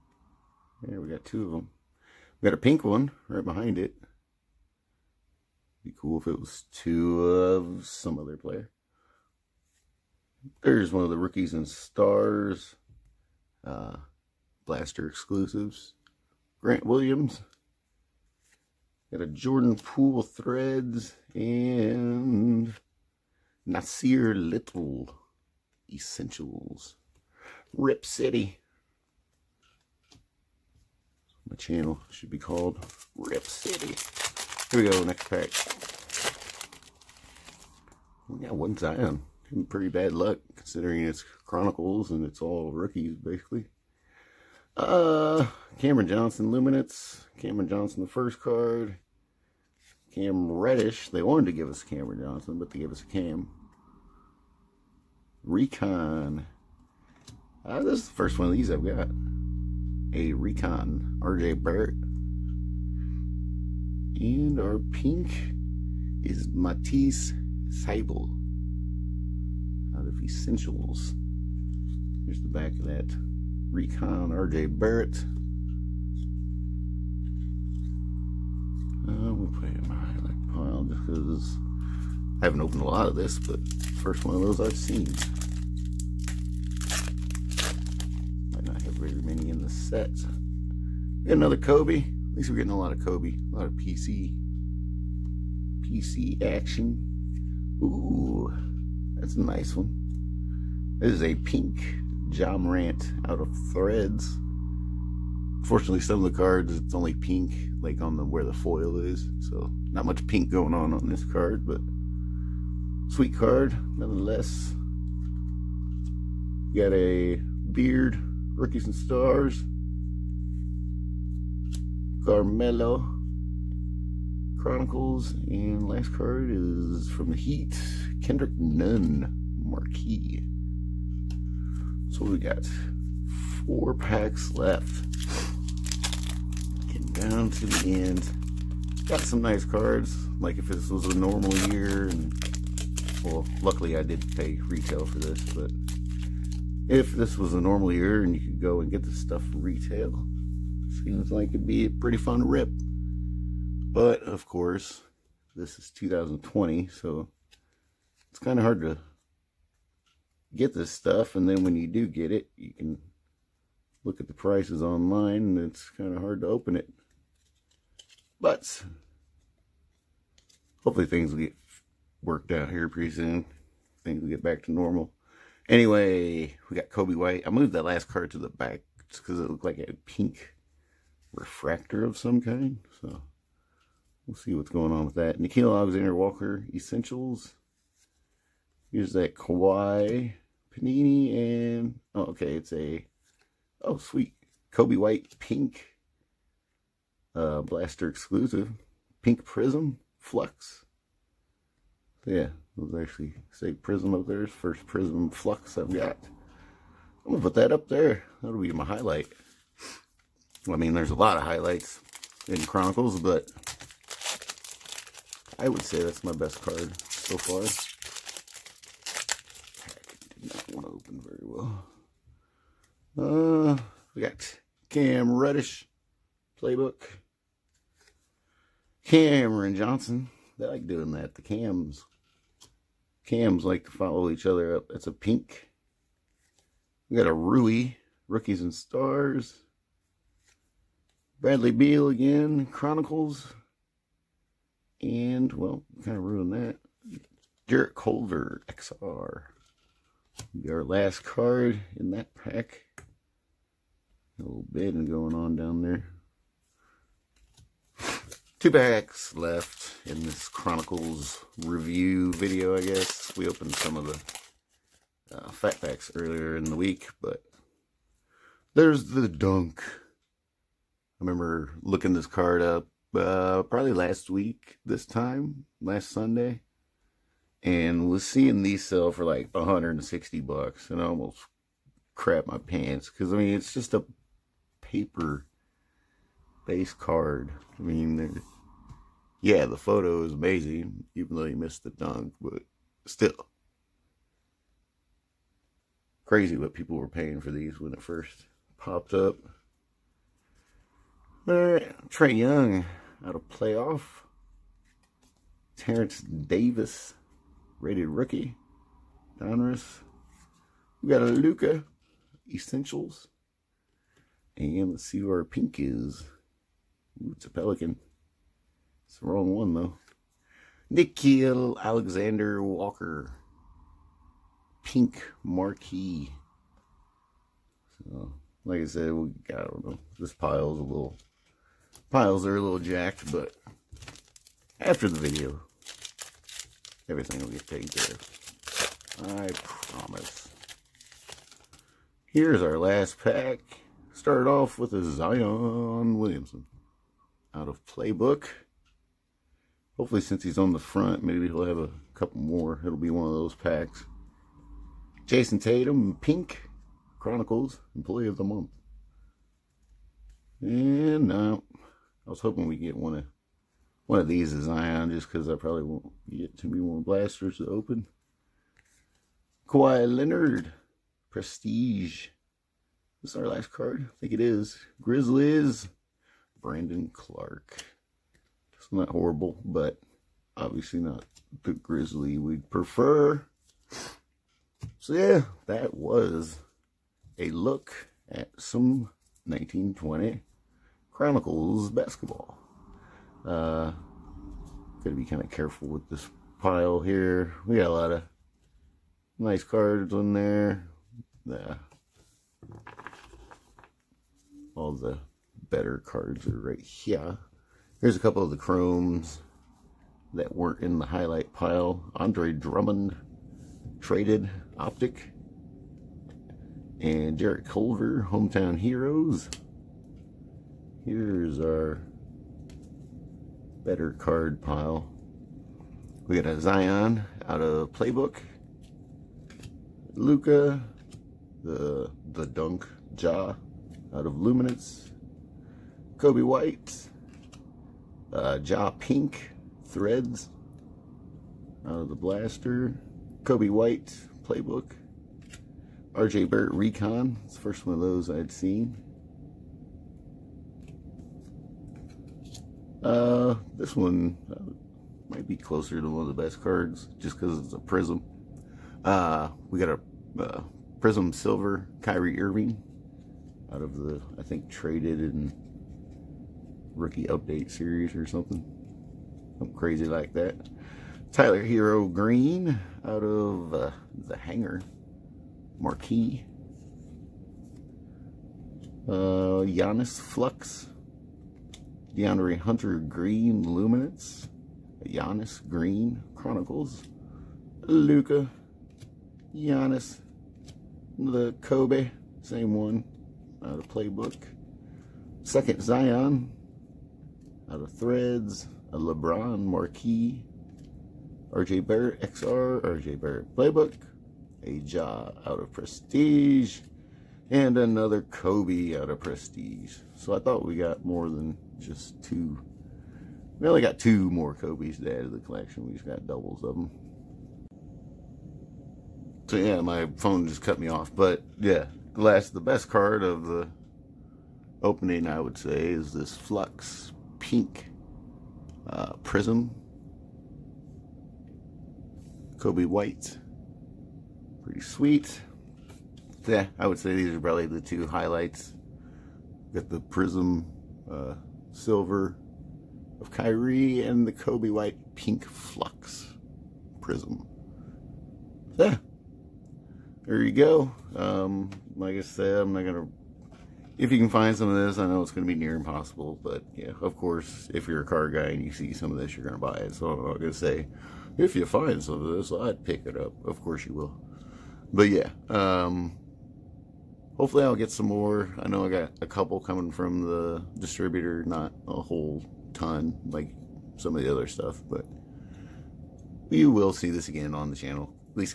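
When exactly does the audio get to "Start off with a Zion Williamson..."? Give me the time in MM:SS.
05:44.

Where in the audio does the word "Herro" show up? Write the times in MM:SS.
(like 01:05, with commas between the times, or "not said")
07:51.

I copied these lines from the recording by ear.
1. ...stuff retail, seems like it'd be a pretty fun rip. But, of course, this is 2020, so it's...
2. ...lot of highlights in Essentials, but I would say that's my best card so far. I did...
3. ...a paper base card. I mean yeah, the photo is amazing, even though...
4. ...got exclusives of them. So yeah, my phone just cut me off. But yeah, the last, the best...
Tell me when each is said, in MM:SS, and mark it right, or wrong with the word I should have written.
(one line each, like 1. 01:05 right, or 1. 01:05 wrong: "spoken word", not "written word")
1. 02:29 right
2. 03:31 wrong: "Chronicles", not "Essentials"
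3. 04:43 right
4. 08:36 wrong: "doubles", not "exclusives".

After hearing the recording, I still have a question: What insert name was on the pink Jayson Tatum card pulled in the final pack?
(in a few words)
Employee of the Month.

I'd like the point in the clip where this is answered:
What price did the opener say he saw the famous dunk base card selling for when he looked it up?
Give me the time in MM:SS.
04:39.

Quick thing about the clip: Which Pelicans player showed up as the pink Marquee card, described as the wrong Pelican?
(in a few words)
Nickeil Alexander-Walker.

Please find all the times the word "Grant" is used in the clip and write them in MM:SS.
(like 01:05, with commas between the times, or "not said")
00:16.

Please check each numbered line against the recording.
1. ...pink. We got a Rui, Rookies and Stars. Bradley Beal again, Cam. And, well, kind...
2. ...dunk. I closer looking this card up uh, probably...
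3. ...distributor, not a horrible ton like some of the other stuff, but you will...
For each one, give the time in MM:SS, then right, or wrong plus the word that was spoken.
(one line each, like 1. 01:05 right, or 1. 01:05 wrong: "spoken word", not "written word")
1. 03:55 wrong: "Chronicles", not "Cam"
2. 04:29 wrong: "remember", not "closer"
3. 09:30 wrong: "whole", not "horrible".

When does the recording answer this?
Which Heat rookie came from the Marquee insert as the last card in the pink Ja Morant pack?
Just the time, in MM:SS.
02:08.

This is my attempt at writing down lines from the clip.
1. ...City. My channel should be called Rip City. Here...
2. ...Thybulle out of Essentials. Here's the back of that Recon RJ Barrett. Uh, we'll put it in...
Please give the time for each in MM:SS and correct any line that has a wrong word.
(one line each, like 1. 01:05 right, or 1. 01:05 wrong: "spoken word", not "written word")
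1. 00:28 right
2. 01:07 right.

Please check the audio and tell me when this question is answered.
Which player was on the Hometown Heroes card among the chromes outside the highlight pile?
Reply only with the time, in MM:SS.
06:57.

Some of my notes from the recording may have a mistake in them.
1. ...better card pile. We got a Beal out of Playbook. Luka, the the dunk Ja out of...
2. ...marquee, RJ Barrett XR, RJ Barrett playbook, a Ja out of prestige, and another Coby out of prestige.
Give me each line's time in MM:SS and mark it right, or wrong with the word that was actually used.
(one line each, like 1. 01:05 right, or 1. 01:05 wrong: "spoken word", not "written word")
1. 07:03 wrong: "Zion", not "Beal"
2. 08:19 right.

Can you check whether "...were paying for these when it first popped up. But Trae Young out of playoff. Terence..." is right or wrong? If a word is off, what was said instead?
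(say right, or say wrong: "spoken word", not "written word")
right.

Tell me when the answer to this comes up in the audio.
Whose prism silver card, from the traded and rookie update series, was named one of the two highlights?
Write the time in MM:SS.
07:42.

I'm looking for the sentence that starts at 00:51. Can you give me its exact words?
They wanted to give us Cameron Johnson, but they gave us a Cam.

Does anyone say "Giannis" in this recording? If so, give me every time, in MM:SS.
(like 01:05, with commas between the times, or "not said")
07:59, 08:05, 08:09.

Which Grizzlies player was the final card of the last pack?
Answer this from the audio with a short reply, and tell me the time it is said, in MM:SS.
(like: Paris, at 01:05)
Brandon Clarke, at 06:16.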